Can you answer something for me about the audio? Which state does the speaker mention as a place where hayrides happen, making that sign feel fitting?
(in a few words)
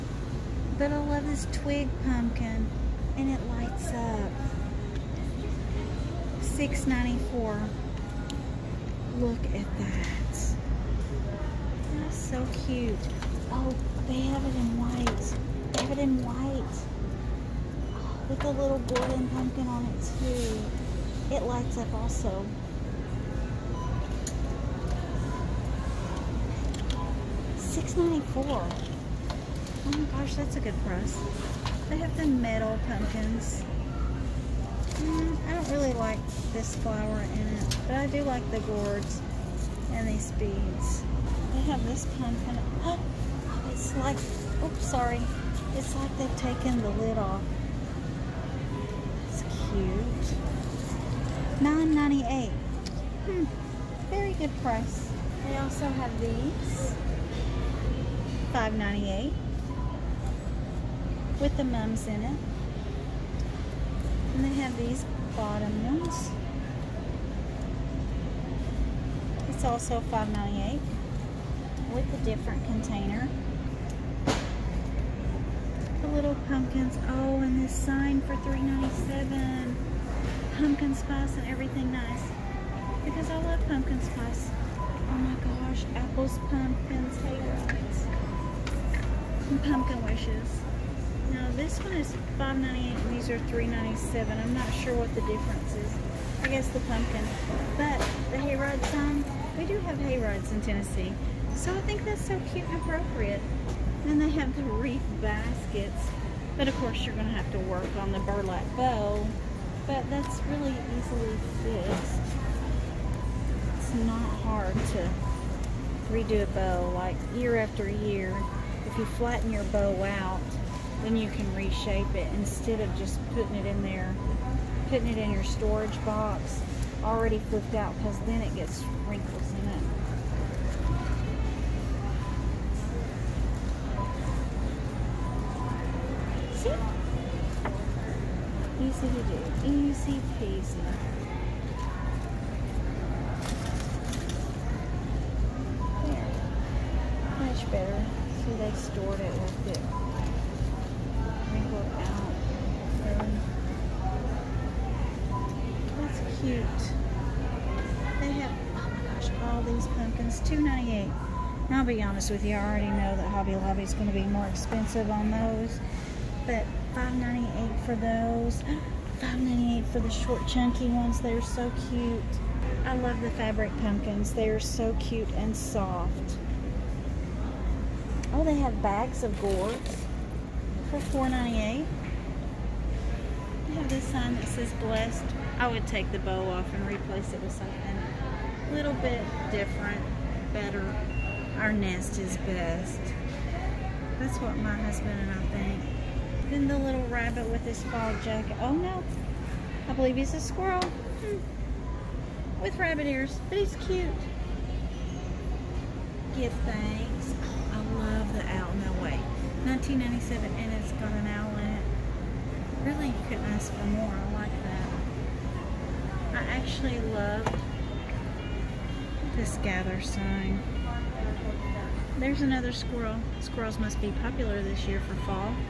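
Tennessee.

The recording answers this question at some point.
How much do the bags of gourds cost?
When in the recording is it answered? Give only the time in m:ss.
3:00.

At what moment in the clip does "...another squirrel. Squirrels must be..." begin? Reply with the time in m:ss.
3:42.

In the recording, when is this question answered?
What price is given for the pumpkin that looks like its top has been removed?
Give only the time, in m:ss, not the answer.
0:51.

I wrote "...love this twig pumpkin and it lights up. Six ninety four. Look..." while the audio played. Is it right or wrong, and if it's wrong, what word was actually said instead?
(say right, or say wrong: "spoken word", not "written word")
right.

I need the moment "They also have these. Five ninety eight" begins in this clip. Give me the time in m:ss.
0:55.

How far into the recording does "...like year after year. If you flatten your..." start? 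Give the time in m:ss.
1:56.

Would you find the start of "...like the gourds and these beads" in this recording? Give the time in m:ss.
0:38.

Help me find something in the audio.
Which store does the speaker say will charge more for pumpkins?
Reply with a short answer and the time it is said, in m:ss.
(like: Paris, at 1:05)
Hobby Lobby, at 2:43.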